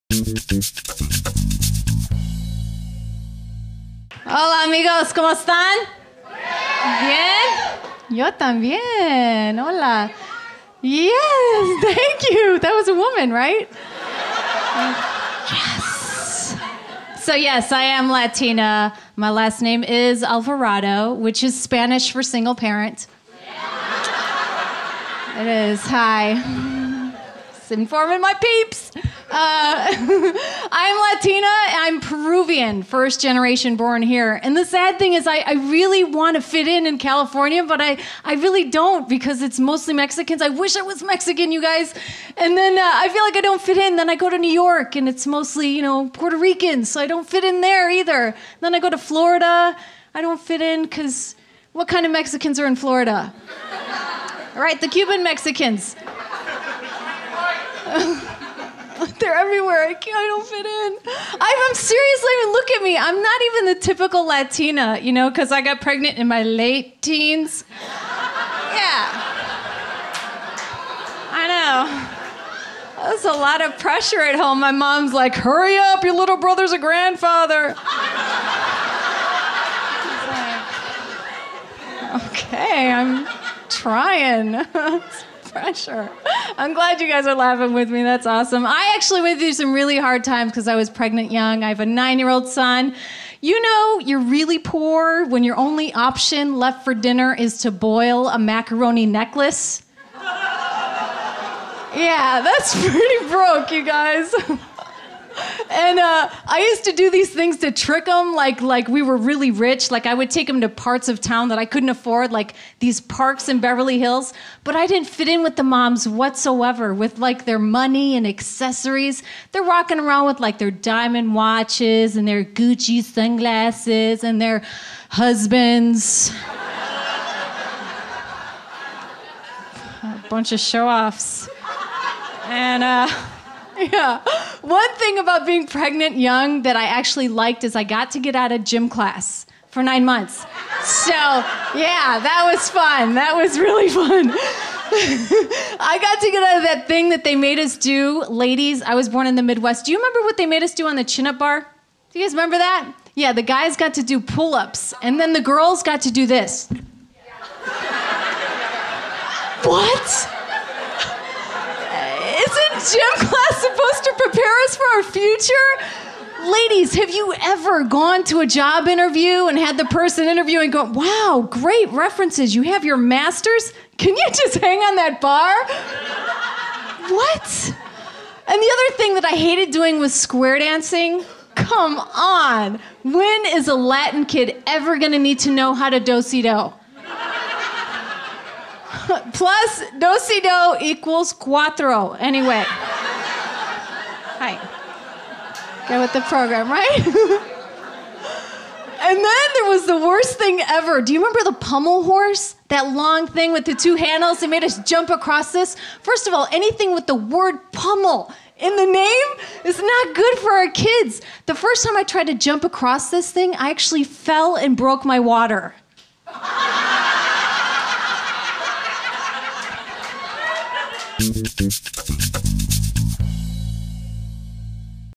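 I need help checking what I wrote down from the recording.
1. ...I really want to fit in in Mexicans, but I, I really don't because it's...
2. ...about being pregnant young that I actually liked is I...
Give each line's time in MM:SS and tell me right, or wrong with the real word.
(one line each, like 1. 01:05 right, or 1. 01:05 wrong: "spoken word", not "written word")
1. 00:35 wrong: "California", not "Mexicans"
2. 02:15 right.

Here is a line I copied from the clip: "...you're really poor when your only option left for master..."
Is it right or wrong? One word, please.
wrong.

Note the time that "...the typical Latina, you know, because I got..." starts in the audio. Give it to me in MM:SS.
01:03.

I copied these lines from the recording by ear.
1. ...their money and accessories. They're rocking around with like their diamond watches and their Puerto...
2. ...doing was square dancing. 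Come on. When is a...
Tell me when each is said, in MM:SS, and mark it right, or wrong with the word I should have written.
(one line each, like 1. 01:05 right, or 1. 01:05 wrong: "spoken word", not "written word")
1. 01:57 wrong: "Gucci", not "Puerto"
2. 02:59 right.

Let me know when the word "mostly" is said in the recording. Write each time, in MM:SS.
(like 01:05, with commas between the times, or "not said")
00:39, 00:45.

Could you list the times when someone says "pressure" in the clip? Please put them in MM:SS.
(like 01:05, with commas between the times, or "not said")
01:13, 01:25.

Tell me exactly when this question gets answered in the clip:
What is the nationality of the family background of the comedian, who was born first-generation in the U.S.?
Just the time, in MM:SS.
00:31.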